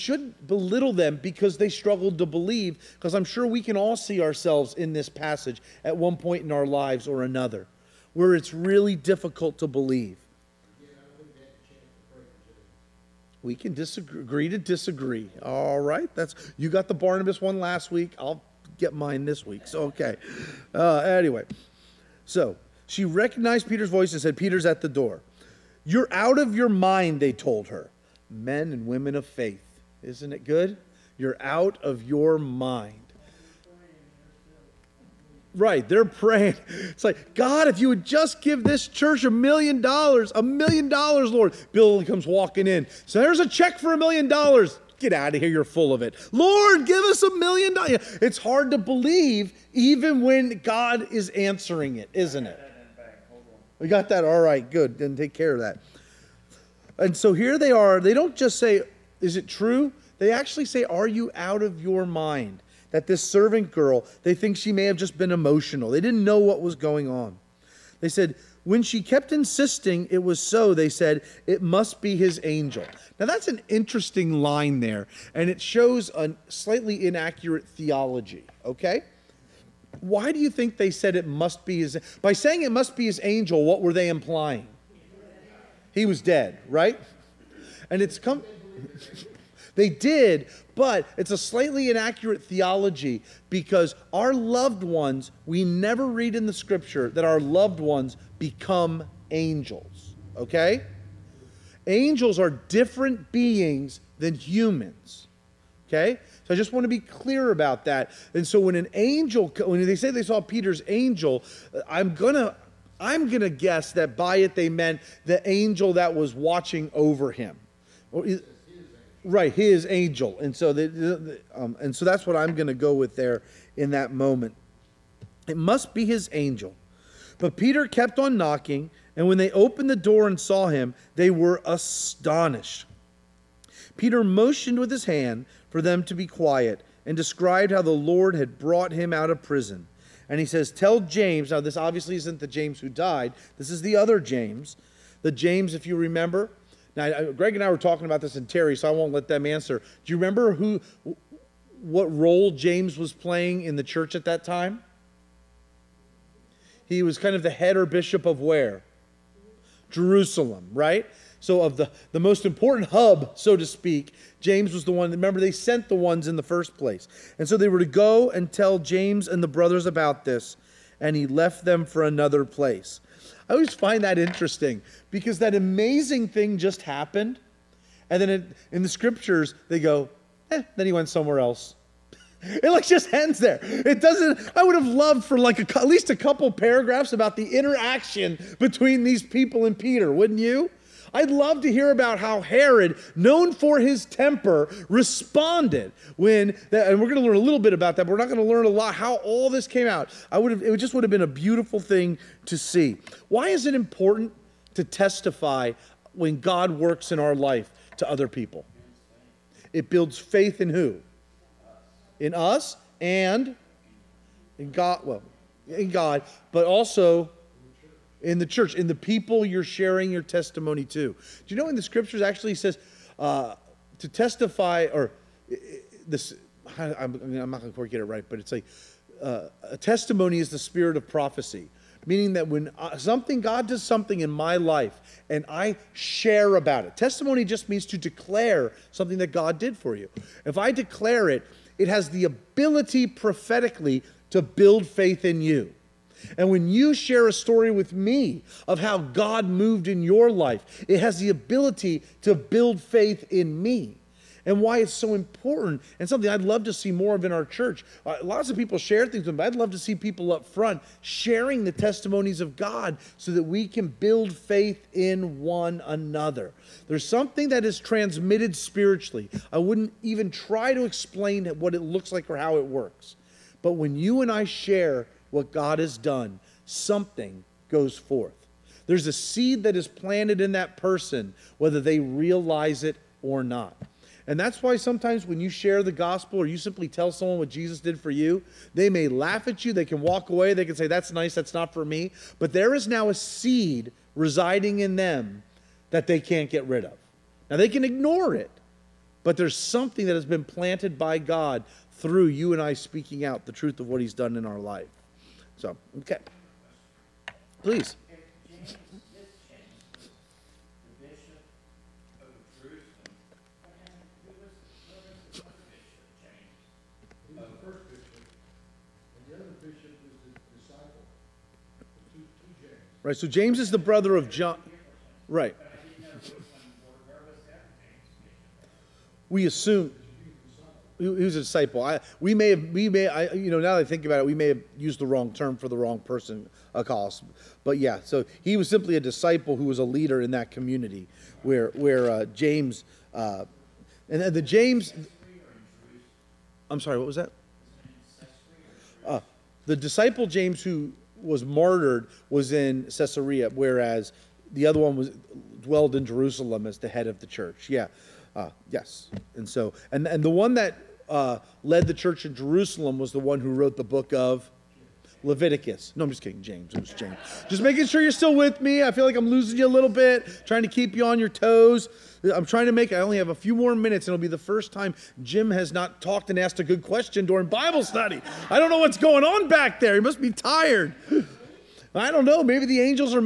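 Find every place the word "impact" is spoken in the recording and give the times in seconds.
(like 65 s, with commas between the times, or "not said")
not said.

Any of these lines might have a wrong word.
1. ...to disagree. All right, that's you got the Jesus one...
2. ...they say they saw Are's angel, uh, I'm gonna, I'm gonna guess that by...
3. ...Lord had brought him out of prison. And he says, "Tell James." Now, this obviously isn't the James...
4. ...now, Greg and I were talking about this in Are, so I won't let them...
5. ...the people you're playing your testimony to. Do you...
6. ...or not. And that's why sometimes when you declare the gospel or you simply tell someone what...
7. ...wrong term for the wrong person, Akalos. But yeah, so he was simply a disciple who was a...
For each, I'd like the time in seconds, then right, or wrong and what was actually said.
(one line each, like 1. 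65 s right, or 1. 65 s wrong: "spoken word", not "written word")
1. 14 s wrong: "Barnabas", not "Jesus"
2. 109 s wrong: "Peter", not "Are"
3. 137 s right
4. 146 s wrong: "Terry", not "Are"
5. 218 s wrong: "sharing", not "playing"
6. 283 s wrong: "share", not "declare"
7. 335 s right.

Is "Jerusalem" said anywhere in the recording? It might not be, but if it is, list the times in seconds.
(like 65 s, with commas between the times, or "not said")
159 s, 356 s, 362 s.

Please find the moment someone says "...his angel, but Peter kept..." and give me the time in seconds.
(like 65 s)
126 s.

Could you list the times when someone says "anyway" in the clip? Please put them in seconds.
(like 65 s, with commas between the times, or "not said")
20 s.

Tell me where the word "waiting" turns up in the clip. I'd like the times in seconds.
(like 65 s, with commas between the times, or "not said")
not said.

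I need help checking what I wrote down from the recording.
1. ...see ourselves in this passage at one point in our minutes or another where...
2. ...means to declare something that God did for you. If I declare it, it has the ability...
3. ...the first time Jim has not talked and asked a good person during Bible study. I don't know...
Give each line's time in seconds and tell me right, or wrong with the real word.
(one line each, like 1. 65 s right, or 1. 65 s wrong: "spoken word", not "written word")
1. 3 s wrong: "lives", not "minutes"
2. 237 s right
3. 374 s wrong: "question", not "person".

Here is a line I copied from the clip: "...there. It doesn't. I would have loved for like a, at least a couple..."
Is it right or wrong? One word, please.
right.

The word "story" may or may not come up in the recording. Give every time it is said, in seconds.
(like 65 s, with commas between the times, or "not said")
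247 s.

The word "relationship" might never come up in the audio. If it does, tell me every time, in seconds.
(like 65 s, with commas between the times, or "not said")
not said.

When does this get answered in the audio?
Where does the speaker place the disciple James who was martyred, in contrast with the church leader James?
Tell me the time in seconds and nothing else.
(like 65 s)
352 s.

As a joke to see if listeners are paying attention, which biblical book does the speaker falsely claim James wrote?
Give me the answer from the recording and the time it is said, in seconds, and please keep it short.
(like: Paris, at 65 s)
Leviticus, at 365 s.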